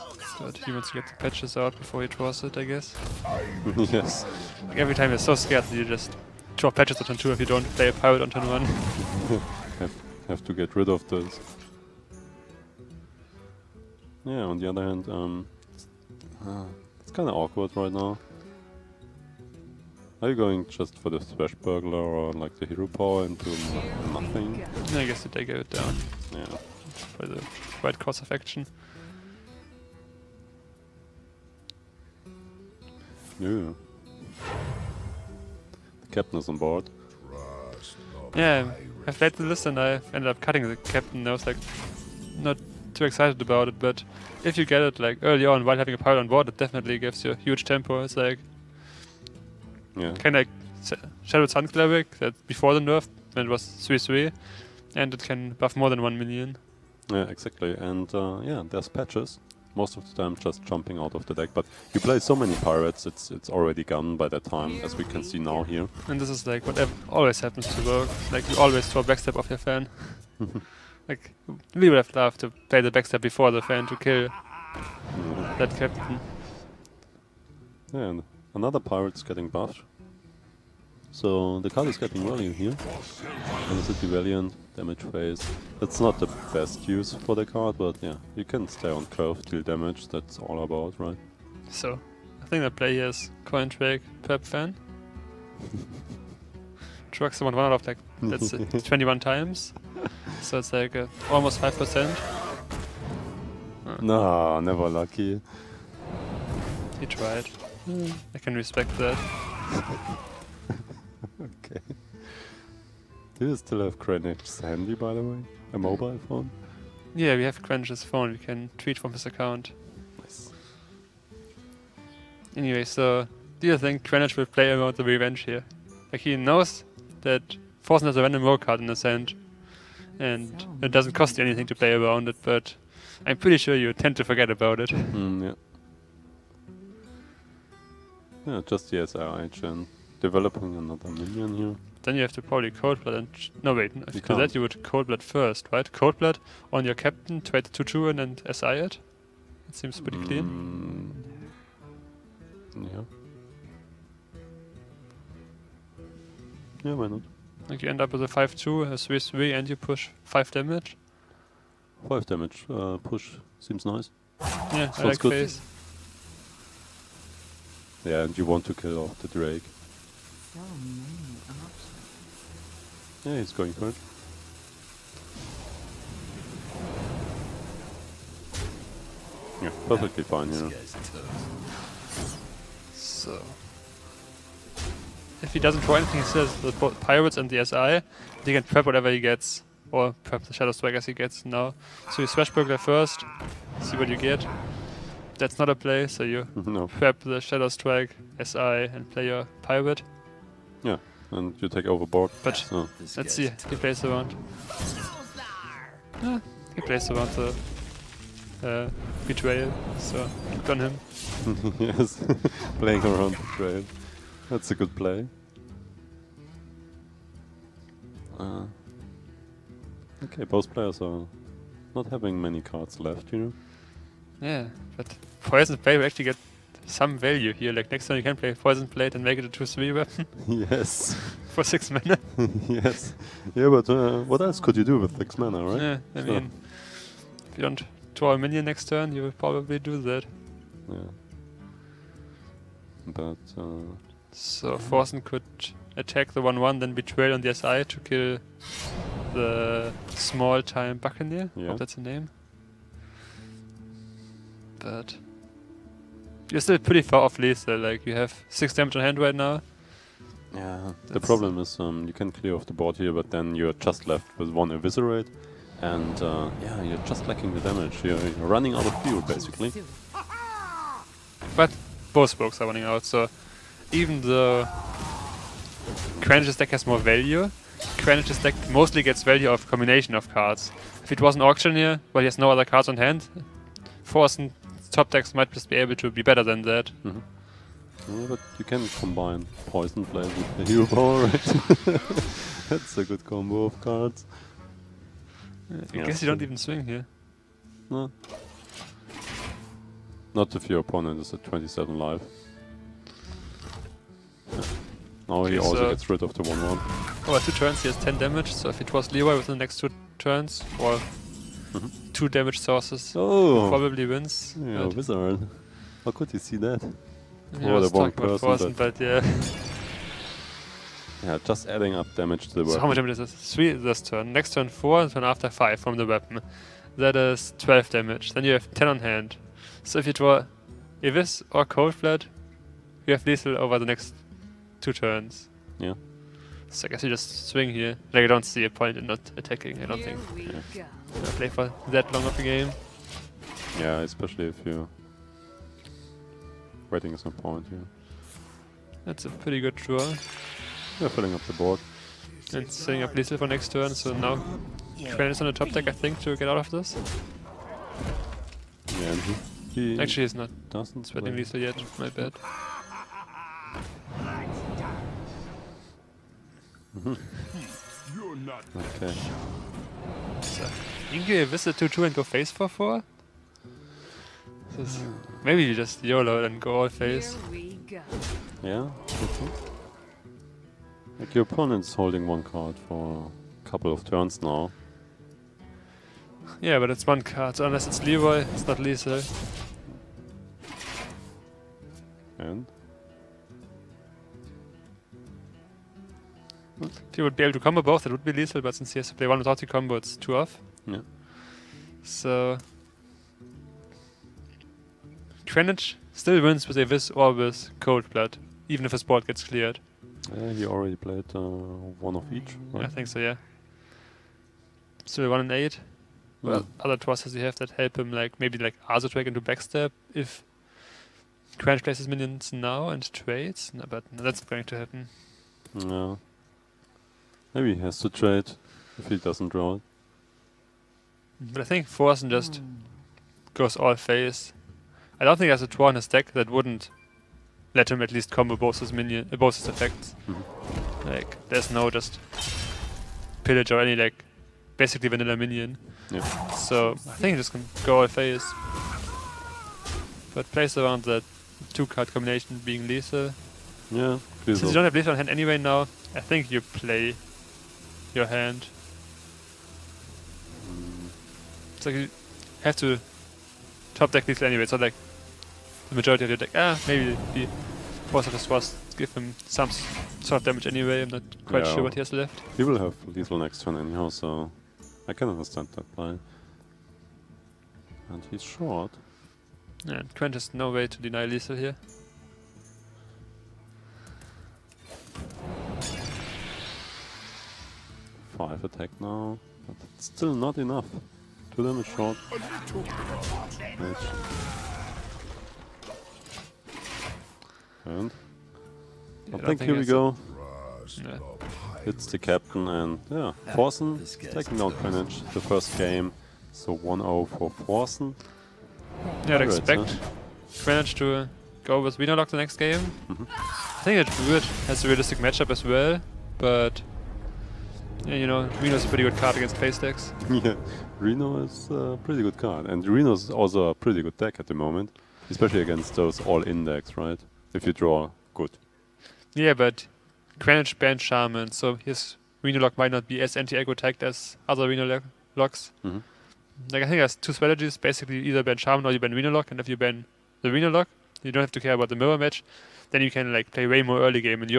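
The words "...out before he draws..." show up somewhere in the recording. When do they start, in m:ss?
0:01.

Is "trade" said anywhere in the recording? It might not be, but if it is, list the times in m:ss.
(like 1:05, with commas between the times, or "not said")
2:27, 7:03, 7:08.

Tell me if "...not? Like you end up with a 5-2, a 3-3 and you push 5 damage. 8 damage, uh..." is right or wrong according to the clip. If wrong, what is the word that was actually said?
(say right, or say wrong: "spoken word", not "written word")
wrong: "5", not "8".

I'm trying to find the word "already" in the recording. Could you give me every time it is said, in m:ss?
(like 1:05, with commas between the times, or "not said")
1:03, 6:50.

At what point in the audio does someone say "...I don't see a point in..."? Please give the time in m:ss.
5:38.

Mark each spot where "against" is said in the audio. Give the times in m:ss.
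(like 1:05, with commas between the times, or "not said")
8:39, 8:45.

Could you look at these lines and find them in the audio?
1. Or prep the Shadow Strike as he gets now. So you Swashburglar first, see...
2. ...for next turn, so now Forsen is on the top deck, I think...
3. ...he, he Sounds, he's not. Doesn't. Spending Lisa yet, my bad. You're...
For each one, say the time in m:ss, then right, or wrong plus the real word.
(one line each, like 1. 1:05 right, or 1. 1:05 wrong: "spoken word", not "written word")
1. 3:09 right
2. 5:53 wrong: "Quinn", not "Forsen"
3. 5:59 wrong: "Actually", not "Sounds".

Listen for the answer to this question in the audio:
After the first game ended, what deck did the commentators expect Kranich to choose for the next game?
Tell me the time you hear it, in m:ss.
8:31.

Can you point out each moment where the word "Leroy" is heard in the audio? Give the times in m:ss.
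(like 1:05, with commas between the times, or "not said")
5:09, 6:28.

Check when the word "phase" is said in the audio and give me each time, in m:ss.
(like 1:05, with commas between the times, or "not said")
1:25, 7:13, 7:28.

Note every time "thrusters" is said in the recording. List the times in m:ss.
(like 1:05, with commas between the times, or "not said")
6:56.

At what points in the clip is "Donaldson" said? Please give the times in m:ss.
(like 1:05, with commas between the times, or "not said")
not said.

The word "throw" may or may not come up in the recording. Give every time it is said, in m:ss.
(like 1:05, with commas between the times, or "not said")
1:08, 3:05.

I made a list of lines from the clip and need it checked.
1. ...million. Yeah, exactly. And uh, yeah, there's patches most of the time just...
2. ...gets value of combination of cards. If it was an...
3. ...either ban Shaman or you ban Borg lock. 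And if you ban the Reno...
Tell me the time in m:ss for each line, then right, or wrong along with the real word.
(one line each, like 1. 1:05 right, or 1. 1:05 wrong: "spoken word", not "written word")
1. 0:56 right
2. 4:39 right
3. 8:58 wrong: "Reno", not "Borg".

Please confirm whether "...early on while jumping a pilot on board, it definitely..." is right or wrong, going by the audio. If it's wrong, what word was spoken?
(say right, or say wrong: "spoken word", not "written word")
wrong: "having", not "jumping".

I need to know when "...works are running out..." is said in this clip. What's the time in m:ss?
4:32.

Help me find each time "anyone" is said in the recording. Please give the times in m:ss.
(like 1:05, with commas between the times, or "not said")
not said.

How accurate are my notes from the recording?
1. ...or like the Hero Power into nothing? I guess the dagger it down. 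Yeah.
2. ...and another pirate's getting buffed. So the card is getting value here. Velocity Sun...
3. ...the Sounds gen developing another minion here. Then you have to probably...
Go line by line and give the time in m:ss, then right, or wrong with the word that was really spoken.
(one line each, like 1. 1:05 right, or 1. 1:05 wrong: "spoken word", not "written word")
1. 0:21 right
2. 1:18 wrong: "Valiant", not "Sun"
3. 2:18 wrong: "SRI", not "Sounds".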